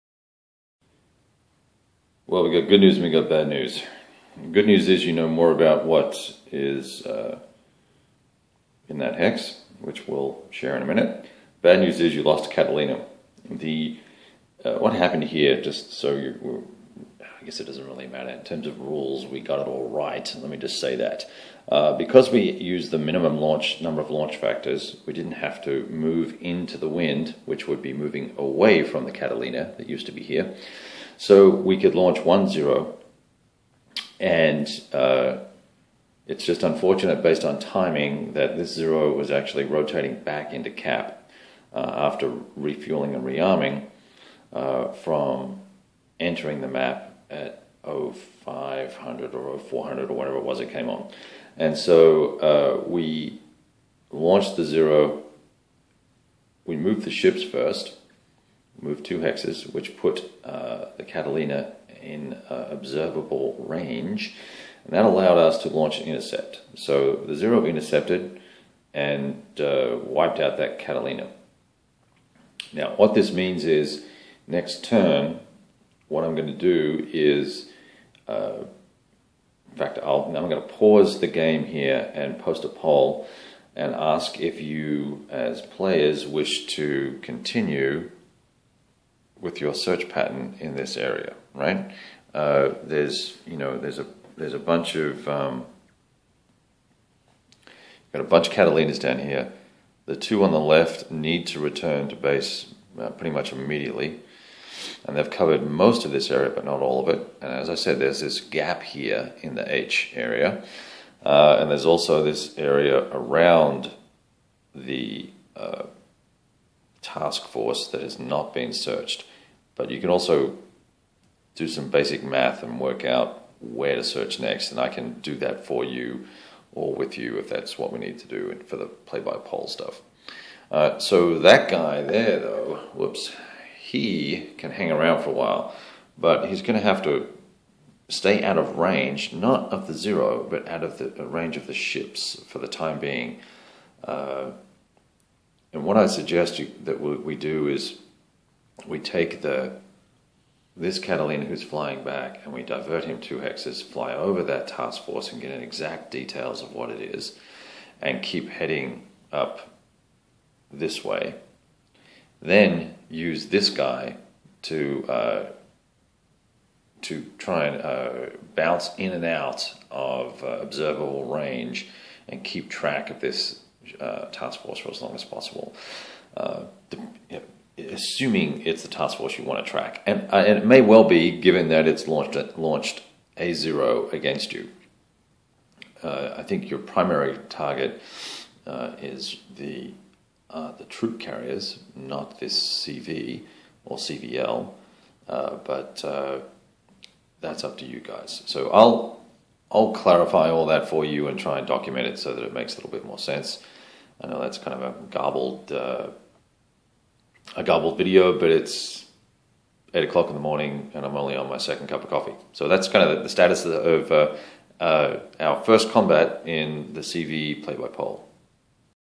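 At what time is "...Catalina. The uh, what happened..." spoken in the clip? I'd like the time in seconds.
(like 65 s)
12 s.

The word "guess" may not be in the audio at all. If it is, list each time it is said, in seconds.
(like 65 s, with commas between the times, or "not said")
17 s.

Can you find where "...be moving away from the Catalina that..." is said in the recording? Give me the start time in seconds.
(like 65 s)
27 s.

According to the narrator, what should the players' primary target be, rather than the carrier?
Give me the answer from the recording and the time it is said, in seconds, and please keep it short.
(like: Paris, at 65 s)
troop carriers, at 190 s.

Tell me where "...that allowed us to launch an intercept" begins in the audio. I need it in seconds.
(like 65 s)
64 s.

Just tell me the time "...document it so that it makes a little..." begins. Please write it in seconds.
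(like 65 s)
201 s.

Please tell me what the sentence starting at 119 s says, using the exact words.
But you can also do some basic math and work out where to search next.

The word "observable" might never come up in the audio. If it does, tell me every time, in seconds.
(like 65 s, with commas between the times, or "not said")
62 s, 170 s.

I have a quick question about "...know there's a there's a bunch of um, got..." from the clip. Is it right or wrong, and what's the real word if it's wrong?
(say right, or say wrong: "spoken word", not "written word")
right.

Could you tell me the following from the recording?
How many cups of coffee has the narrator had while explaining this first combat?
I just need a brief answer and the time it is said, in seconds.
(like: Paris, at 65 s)
2, at 211 s.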